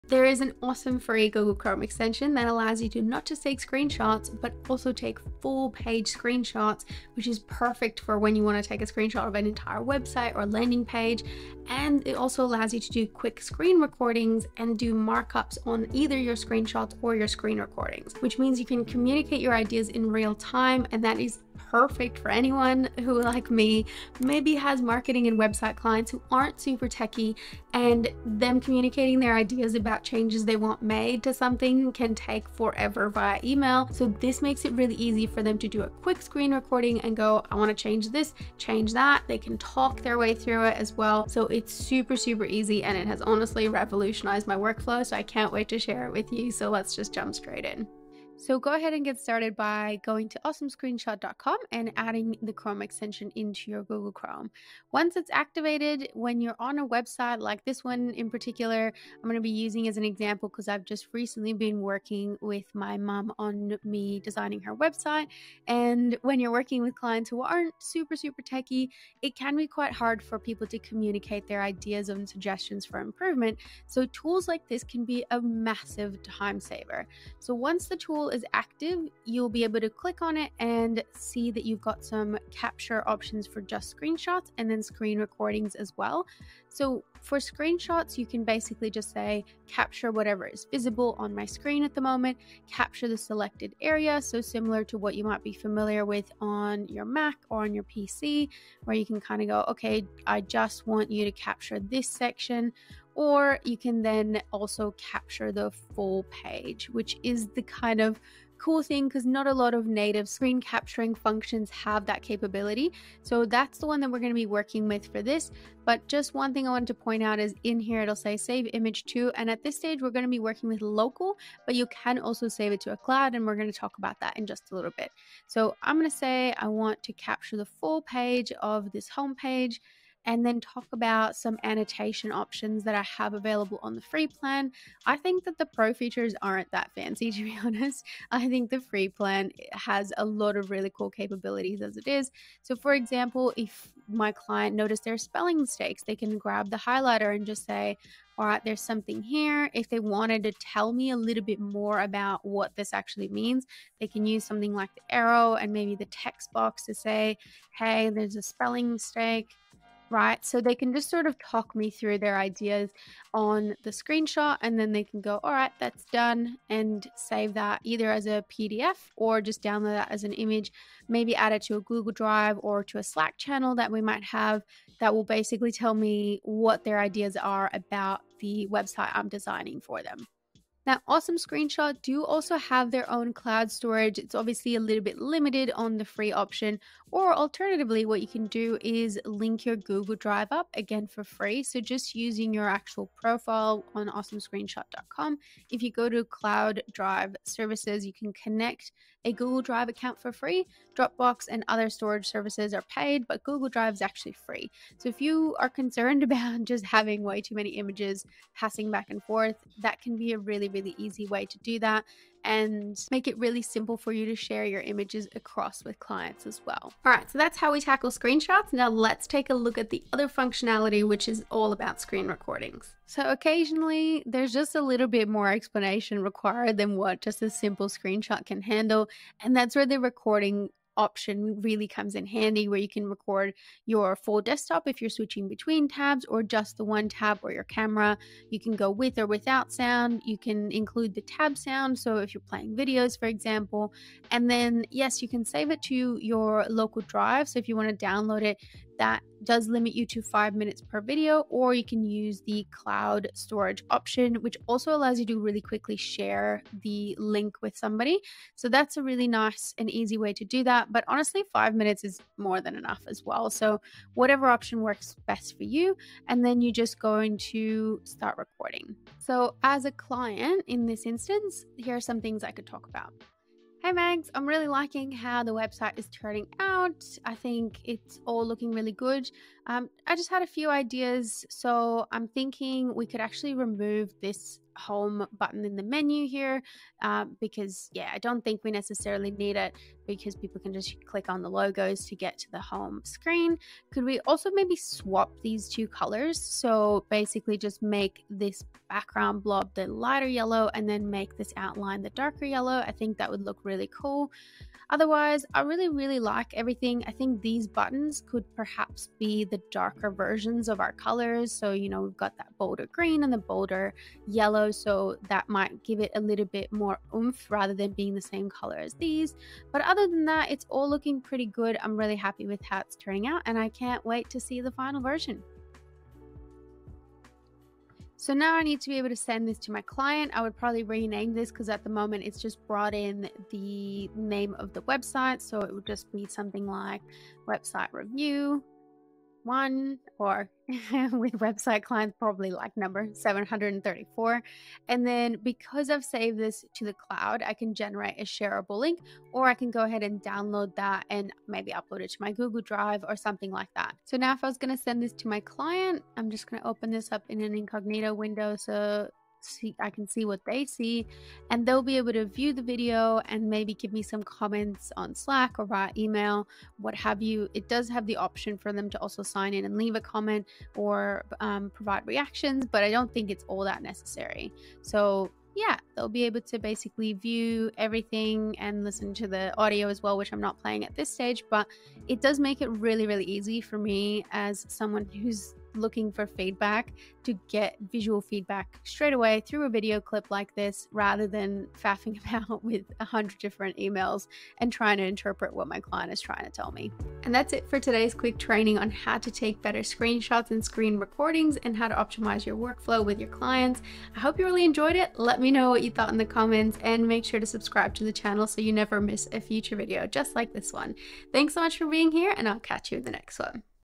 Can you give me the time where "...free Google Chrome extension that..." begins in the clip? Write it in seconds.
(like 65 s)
0 s.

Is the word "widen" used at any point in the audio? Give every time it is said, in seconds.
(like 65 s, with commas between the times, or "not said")
not said.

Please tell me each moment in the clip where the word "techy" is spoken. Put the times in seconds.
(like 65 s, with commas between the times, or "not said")
26 s, 68 s.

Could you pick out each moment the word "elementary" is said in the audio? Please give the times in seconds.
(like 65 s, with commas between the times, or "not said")
not said.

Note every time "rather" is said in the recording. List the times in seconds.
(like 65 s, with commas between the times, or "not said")
317 s, 390 s.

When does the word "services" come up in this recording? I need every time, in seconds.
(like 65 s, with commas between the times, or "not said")
197 s, 202 s.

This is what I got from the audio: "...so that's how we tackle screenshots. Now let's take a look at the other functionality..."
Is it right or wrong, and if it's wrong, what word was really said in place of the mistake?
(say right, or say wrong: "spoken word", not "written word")
right.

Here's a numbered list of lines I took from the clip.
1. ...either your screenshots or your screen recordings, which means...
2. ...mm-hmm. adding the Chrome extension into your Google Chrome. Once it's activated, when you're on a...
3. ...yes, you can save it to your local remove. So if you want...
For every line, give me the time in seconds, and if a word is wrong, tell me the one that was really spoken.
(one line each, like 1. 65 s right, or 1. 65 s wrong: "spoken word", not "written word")
1. 15 s right
2. 51 s right
3. 244 s wrong: "drive", not "remove".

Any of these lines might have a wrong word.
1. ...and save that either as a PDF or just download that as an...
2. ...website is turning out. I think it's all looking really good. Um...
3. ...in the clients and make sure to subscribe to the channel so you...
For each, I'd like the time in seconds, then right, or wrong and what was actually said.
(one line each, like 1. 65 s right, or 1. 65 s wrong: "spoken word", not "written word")
1. 166 s right
2. 275 s right
3. 406 s wrong: "comments", not "clients".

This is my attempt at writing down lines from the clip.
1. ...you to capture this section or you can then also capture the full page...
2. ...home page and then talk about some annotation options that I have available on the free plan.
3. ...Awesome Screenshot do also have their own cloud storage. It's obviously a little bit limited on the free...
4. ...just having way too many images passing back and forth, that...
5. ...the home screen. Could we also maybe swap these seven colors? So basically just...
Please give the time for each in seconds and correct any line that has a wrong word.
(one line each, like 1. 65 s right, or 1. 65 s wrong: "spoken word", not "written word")
1. 101 s right
2. 129 s right
3. 181 s right
4. 206 s right
5. 292 s wrong: "two", not "seven".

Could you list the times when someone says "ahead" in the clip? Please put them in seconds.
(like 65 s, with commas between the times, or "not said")
48 s, 349 s.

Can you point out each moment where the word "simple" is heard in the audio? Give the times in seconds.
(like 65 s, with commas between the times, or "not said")
213 s, 227 s.